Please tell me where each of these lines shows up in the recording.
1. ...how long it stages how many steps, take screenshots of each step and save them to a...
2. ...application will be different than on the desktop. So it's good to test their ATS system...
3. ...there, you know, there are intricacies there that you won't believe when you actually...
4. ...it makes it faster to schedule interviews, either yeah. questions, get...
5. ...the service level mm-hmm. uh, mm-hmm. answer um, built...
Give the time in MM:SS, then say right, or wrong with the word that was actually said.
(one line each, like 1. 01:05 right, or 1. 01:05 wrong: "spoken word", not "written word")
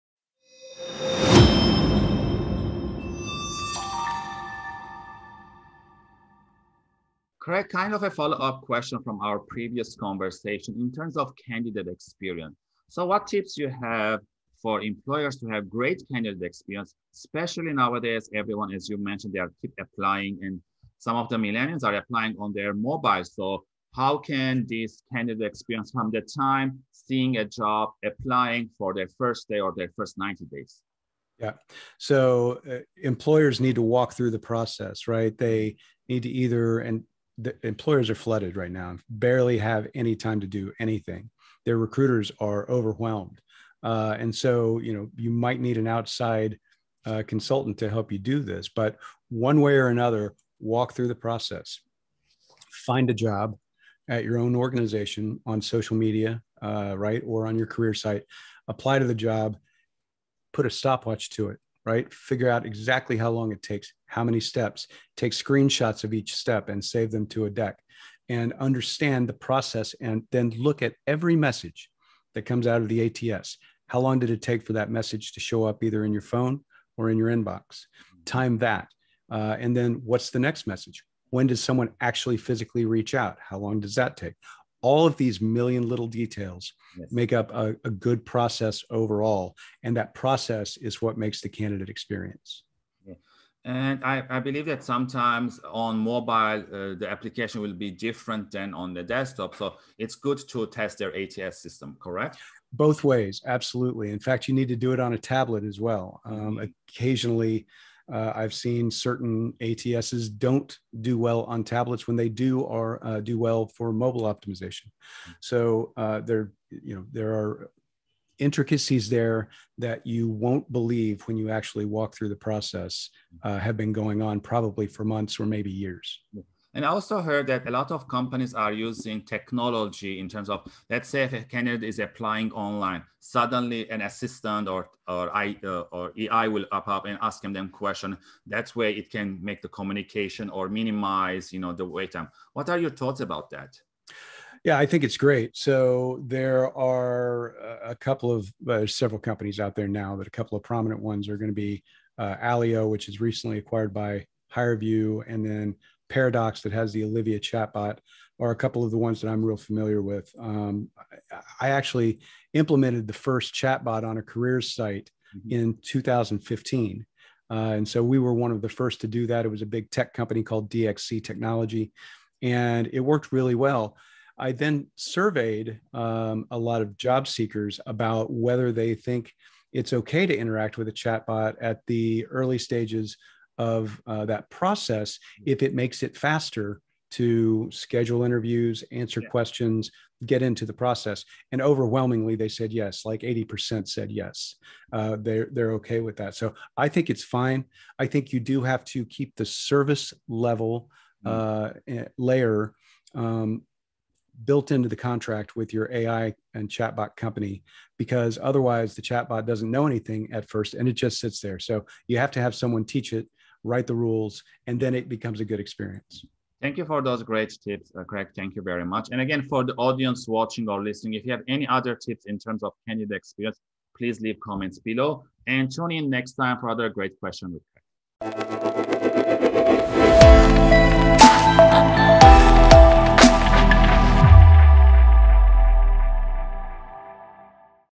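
1. 01:03 wrong: "takes", not "stages"
2. 01:37 right
3. 01:56 right
4. 03:05 wrong: "answer", not "either"
5. 03:19 wrong: "layer", not "answer".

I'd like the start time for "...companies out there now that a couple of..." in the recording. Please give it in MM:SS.
02:29.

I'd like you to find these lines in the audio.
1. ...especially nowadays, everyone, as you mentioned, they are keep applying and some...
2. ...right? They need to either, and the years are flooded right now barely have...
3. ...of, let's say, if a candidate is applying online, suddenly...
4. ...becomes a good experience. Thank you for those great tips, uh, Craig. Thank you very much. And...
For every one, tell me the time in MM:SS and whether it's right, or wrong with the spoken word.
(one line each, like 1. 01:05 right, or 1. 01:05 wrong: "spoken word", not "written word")
1. 00:17 right
2. 00:35 wrong: "employers", not "years"
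3. 02:10 right
4. 03:35 right.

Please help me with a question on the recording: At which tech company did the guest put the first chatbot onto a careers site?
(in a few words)
DXC Technology.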